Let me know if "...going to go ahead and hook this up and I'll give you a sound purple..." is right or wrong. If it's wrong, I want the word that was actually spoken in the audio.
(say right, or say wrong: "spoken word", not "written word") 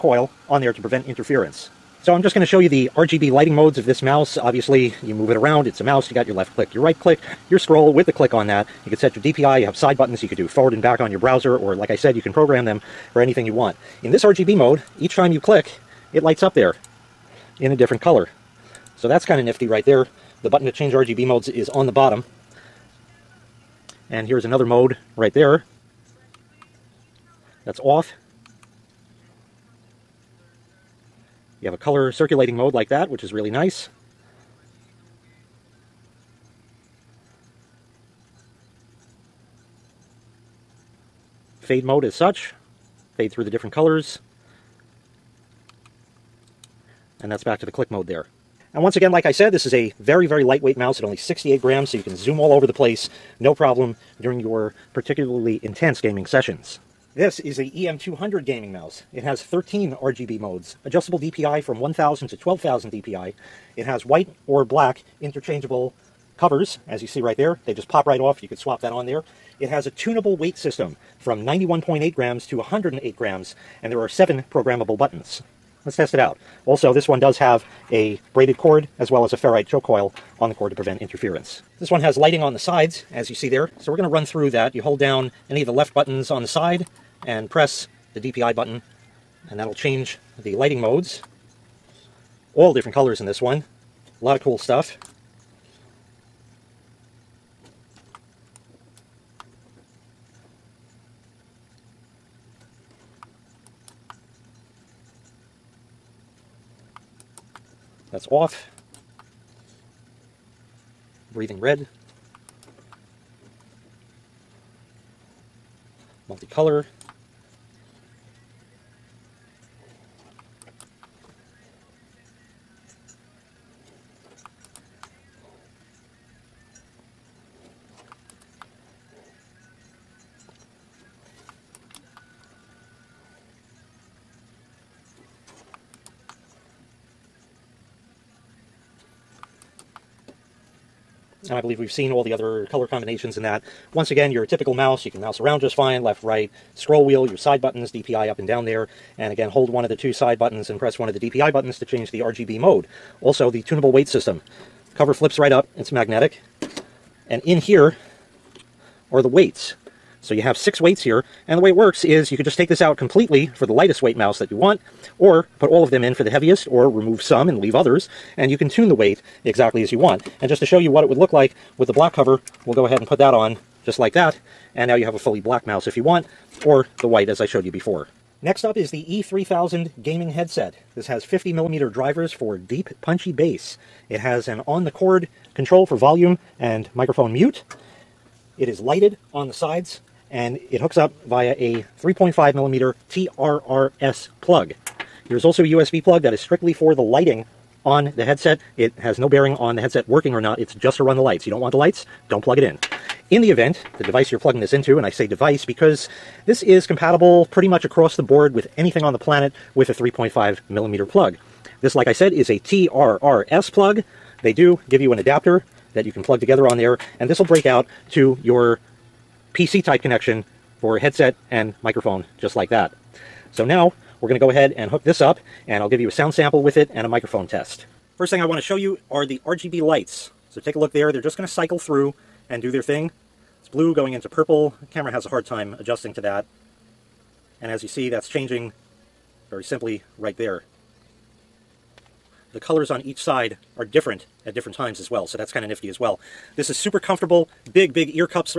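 wrong: "sample", not "purple".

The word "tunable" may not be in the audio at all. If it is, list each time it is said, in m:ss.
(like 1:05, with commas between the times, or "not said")
1:09, 2:33.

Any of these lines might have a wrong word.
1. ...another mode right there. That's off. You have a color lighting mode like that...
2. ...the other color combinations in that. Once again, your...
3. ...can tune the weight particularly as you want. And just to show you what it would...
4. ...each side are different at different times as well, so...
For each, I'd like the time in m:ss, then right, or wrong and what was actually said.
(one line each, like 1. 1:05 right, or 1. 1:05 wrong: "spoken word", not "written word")
1. 0:24 wrong: "circulating", not "lighting"
2. 2:22 right
3. 2:48 wrong: "exactly", not "particularly"
4. 4:03 right.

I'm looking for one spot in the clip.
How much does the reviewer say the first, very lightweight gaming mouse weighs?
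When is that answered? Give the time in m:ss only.
0:51.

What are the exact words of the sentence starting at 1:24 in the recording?
You hold down any of the left buttons on the side and press the DPI button, and that'll change the lighting modes.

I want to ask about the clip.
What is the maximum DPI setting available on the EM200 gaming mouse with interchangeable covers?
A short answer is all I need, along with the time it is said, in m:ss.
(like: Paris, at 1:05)
12,000 DPI, at 1:02.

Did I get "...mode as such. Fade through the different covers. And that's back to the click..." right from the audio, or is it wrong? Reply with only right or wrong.
wrong.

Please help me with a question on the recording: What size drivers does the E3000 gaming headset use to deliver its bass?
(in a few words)
50 millimeter.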